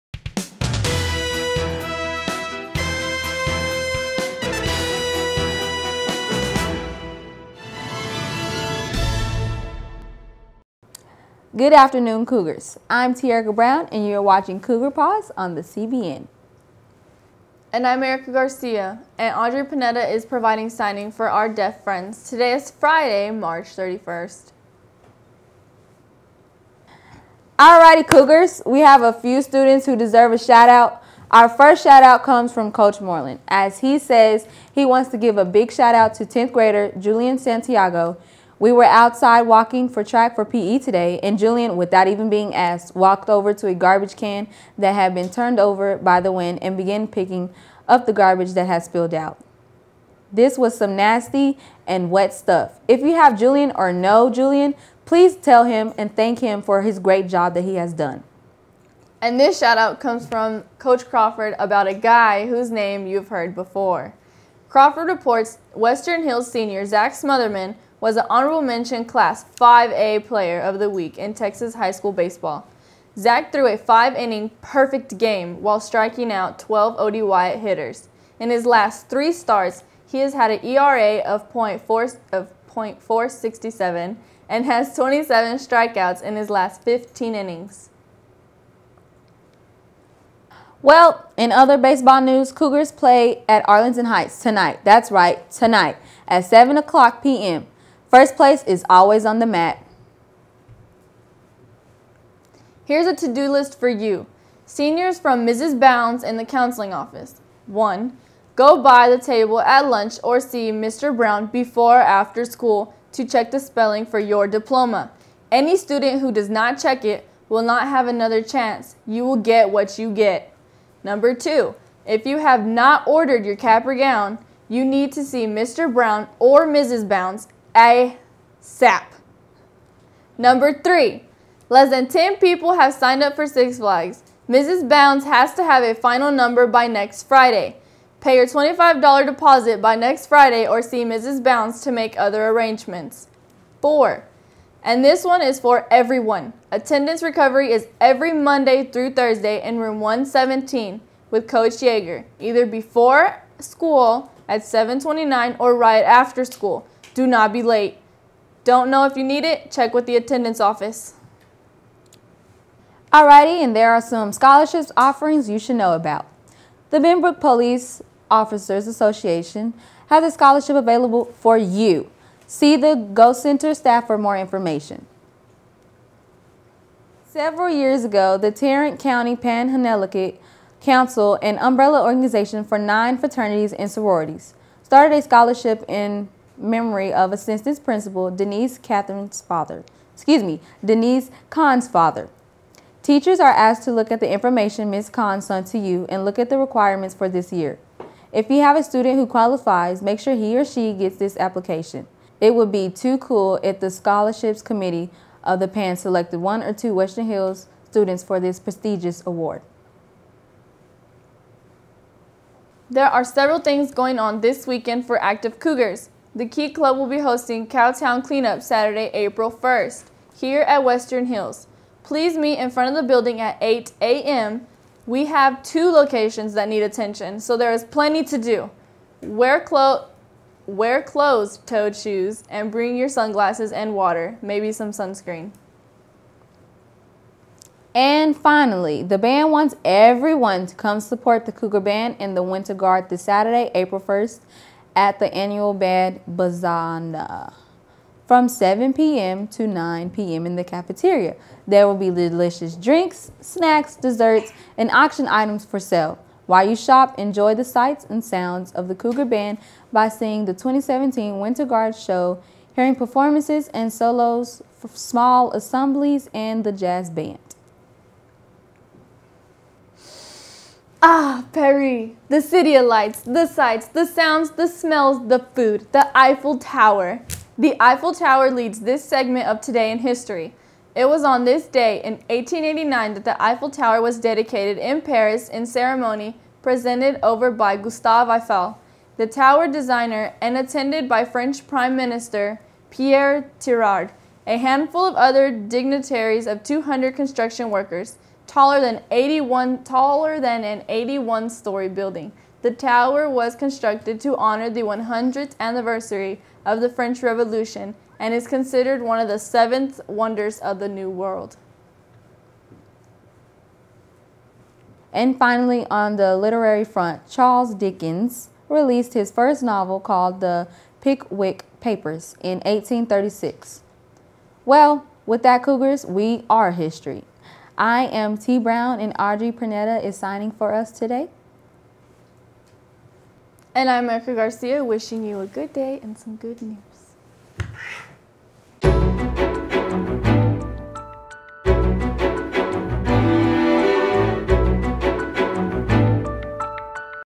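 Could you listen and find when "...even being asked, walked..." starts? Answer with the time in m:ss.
0:42.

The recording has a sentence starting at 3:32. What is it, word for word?
There are several things going on this weekend for active Cougars.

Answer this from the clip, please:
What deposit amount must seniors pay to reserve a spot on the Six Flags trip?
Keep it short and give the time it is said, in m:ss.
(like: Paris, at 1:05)
$25, at 2:18.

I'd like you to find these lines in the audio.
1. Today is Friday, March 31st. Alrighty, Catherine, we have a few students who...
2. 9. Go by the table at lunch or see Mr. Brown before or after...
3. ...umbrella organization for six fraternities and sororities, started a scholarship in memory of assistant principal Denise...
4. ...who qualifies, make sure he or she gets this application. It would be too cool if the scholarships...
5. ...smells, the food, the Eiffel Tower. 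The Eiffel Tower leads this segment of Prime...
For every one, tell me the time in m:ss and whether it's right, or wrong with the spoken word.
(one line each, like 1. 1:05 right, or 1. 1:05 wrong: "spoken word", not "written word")
1. 0:22 wrong: "Cougars", not "Catherine"
2. 1:47 wrong: "1", not "9"
3. 3:01 wrong: "nine", not "six"
4. 3:19 right
5. 4:34 wrong: "Today", not "Prime".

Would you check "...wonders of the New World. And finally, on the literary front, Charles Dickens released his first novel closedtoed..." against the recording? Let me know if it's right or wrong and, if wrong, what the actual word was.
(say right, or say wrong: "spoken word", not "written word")
wrong: "called", not "closedtoed".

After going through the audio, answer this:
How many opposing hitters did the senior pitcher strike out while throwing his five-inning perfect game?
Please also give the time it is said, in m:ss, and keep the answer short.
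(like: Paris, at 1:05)
12, at 1:16.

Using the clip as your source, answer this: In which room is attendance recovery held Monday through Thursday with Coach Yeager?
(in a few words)
117.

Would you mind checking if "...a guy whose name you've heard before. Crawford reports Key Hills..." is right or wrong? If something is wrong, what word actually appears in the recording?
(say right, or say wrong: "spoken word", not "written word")
wrong: "Western", not "Key".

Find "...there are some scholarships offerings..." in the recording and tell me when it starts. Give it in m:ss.
2:43.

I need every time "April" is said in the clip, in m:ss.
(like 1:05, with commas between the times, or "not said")
3:39, 4:03.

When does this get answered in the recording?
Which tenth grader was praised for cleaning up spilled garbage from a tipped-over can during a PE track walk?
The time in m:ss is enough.
0:36.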